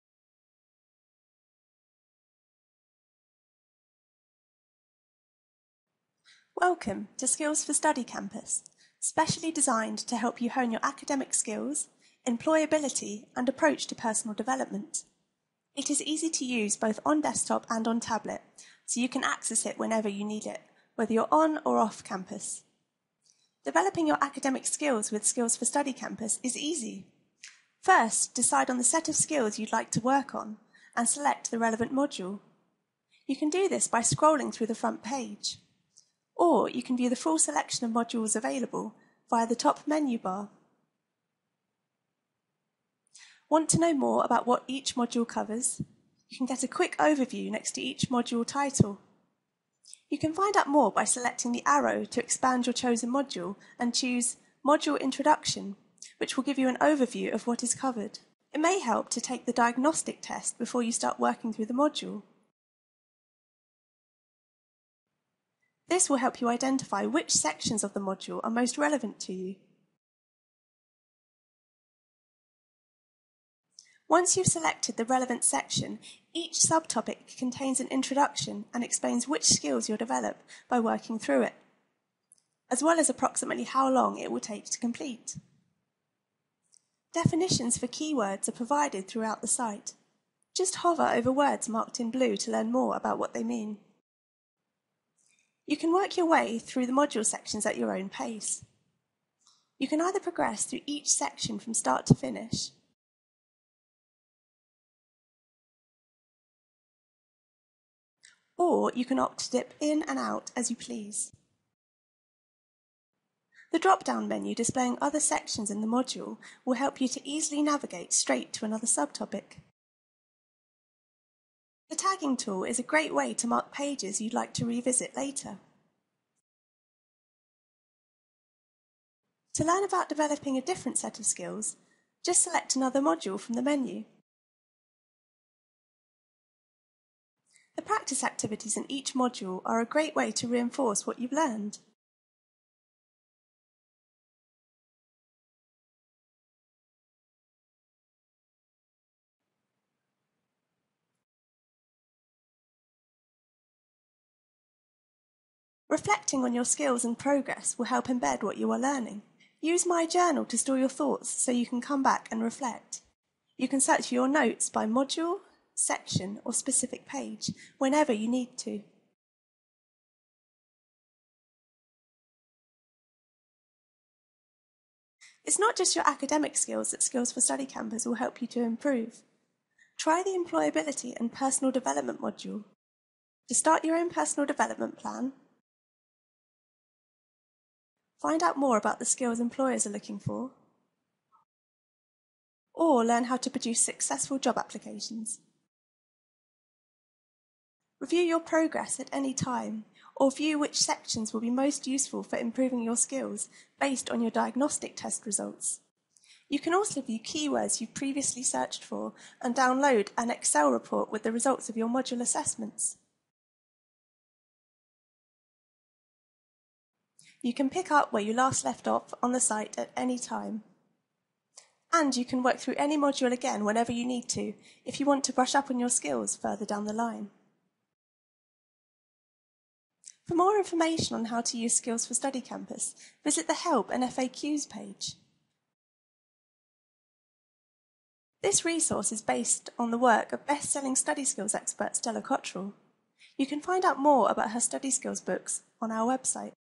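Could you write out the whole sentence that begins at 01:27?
Definitions for keywords are provided throughout the site.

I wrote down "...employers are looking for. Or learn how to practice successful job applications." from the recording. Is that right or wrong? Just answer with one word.
wrong.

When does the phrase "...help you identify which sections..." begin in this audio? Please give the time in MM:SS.
01:06.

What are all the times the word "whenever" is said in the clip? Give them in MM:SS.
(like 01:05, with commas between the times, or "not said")
00:19, 02:47, 03:43.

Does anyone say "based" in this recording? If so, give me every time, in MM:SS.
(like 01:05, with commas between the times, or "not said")
03:23, 03:59.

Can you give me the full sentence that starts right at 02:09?
To learn about developing a different set of skills, just select another module from the menu.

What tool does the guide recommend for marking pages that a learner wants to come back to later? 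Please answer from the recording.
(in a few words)
The tagging tool.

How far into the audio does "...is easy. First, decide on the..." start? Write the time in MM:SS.
00:26.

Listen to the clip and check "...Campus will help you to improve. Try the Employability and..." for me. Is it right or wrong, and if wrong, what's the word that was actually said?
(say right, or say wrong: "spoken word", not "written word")
right.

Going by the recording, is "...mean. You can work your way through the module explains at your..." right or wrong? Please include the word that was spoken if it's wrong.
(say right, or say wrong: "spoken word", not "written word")
wrong: "sections", not "explains".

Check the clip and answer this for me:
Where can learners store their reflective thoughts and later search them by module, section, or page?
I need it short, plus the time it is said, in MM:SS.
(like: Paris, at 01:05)
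My Journal, at 02:39.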